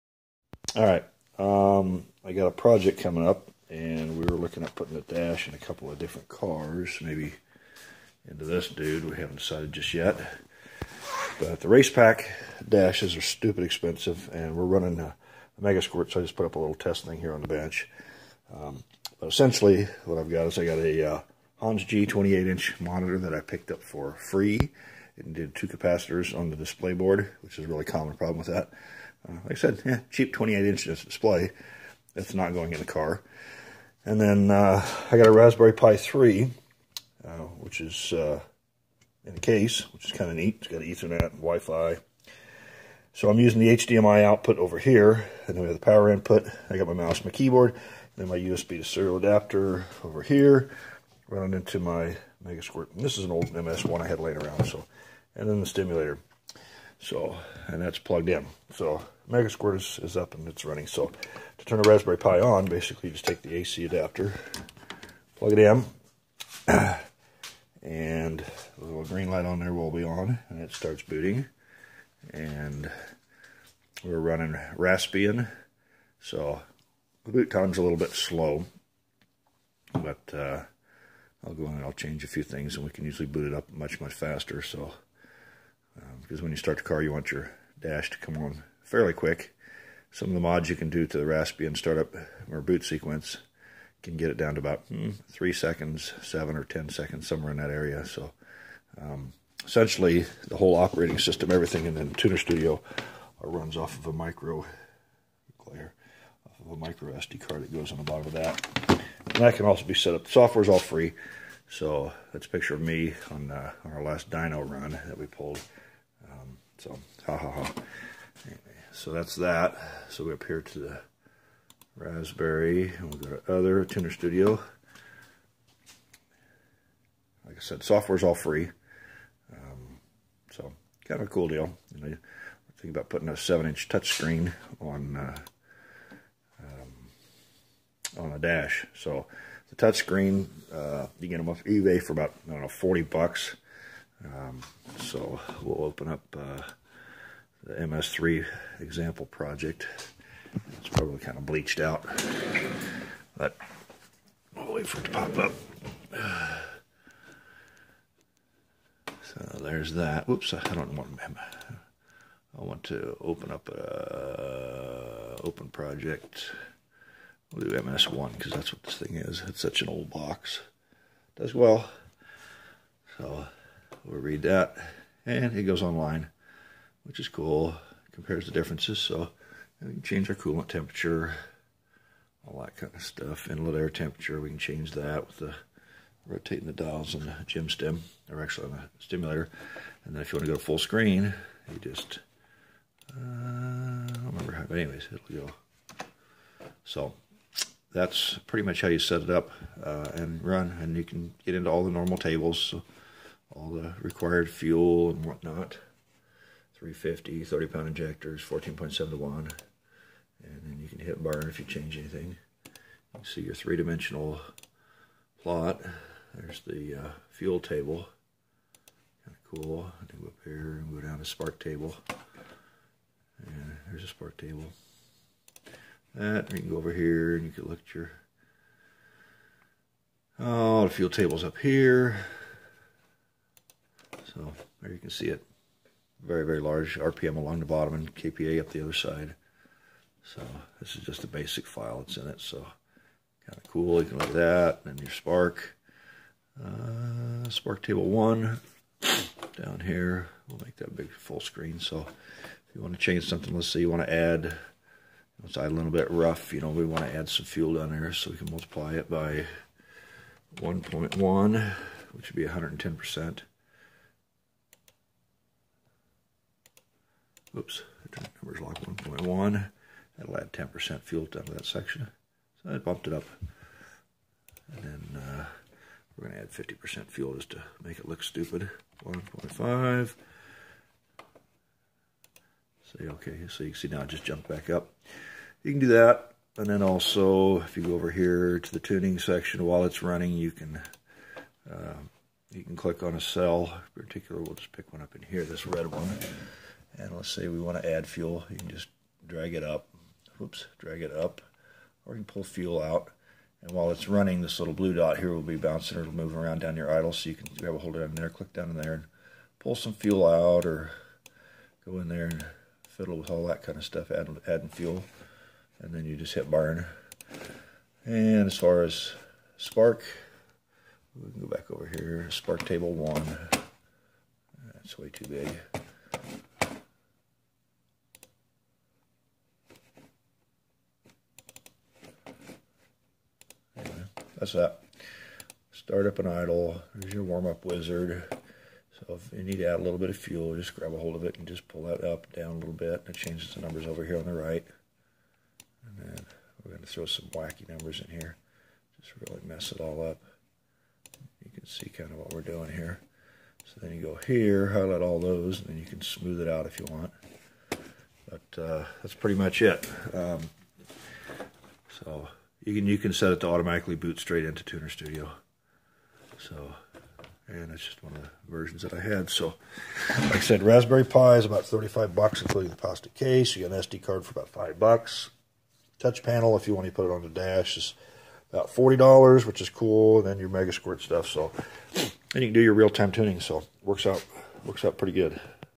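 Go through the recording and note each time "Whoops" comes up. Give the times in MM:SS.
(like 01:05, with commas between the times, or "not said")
02:40, 05:00.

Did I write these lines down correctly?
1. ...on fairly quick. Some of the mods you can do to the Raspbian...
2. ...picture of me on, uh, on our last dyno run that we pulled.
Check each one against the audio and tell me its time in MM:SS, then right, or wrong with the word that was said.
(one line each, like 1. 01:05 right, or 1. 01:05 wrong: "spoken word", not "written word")
1. 01:28 right
2. 01:52 right.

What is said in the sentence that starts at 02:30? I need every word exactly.
It's probably kind of bleached out, but we'll wait for it to pop up.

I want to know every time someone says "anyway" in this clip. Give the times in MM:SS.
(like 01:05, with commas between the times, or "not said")
01:58, 03:14.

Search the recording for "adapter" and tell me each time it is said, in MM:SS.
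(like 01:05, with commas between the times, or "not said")
00:49, 01:03.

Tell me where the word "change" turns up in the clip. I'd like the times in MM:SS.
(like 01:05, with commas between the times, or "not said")
01:21, 03:00, 03:04, 03:31, 04:12, 05:43.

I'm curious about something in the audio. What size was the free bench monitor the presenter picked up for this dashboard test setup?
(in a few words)
28-inch.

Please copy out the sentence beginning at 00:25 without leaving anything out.
It did two capacitors on the display board, which is a really common problem with that.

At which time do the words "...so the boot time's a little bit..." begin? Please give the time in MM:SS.
01:16.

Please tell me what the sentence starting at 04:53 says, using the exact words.
In particular, we'll just pick one up in here, this red one.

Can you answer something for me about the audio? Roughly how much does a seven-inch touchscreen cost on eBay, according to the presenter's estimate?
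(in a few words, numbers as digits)
$40.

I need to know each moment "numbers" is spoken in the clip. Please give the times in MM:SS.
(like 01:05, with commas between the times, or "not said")
04:28, 05:43, 05:47.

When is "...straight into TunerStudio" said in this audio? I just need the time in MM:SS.
06:04.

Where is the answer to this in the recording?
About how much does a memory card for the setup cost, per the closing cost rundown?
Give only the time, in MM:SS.
06:14.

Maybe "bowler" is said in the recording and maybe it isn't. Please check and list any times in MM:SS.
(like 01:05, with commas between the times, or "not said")
not said.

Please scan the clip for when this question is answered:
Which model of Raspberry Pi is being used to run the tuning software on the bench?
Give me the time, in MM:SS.
00:35.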